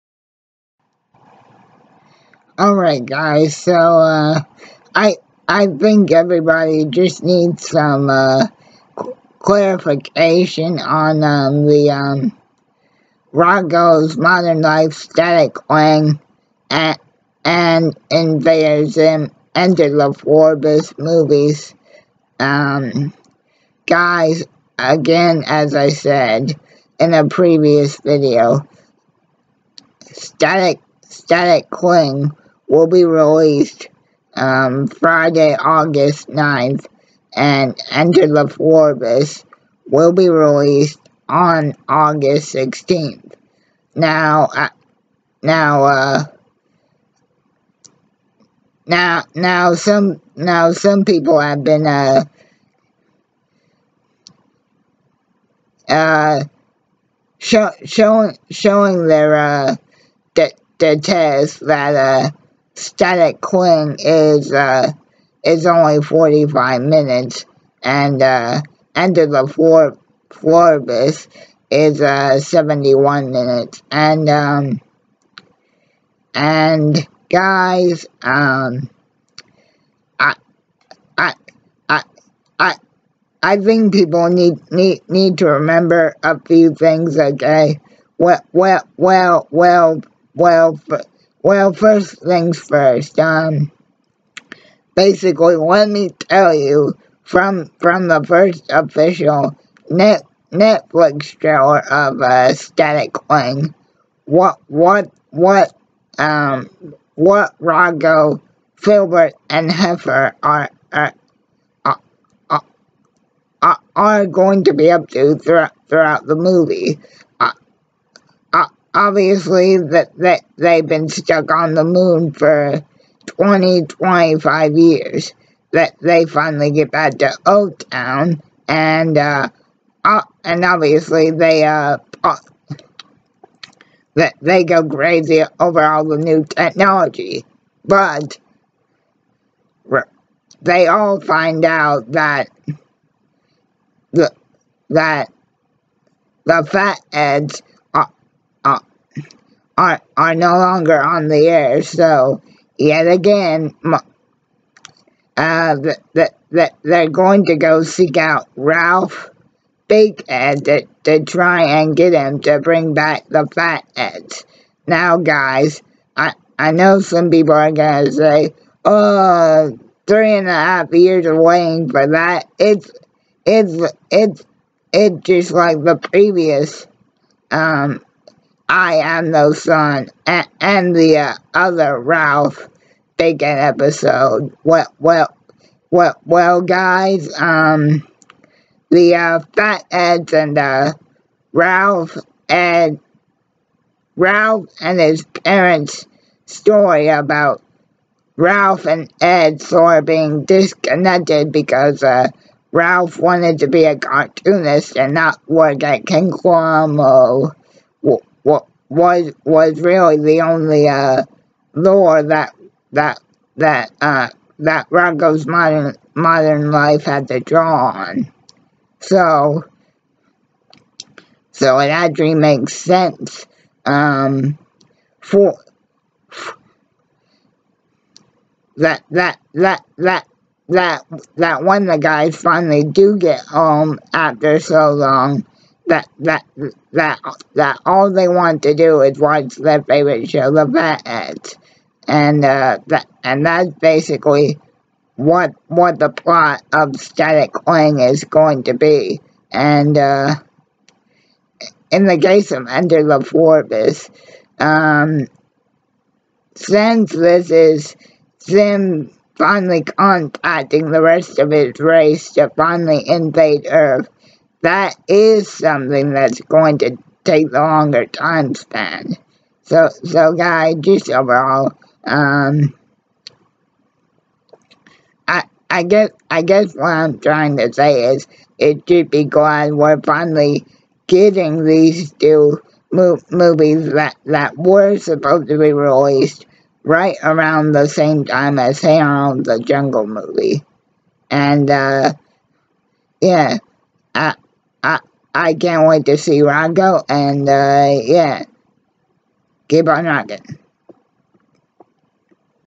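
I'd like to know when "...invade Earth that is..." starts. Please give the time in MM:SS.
04:23.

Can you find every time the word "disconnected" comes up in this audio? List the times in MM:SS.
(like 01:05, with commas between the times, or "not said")
03:20.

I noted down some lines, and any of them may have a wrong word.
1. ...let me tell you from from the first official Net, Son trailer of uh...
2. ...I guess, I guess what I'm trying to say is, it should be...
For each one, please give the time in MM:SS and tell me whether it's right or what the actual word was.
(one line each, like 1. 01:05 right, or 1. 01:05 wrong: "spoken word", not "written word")
1. 01:35 wrong: "Netflix", not "Son"
2. 04:35 right.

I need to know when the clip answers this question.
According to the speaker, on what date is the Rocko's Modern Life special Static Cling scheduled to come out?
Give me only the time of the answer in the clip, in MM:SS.
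00:34.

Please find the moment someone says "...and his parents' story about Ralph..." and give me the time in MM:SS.
03:14.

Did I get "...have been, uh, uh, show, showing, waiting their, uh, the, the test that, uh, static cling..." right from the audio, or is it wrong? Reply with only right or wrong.
wrong.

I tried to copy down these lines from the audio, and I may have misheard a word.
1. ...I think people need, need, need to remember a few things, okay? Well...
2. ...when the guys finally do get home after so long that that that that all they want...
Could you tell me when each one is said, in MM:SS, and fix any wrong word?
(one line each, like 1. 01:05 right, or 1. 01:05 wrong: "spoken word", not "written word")
1. 01:23 right
2. 03:51 right.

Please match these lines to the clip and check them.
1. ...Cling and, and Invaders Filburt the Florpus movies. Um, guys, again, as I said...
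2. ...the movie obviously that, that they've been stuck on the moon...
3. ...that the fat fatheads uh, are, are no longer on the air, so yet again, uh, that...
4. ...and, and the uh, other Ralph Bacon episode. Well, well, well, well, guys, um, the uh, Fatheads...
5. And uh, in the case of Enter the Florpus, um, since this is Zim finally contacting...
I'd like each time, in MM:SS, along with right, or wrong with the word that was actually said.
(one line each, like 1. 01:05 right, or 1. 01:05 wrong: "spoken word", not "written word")
1. 00:15 wrong: "Enter", not "Filburt"
2. 01:56 right
3. 02:24 right
4. 03:00 right
5. 04:09 right.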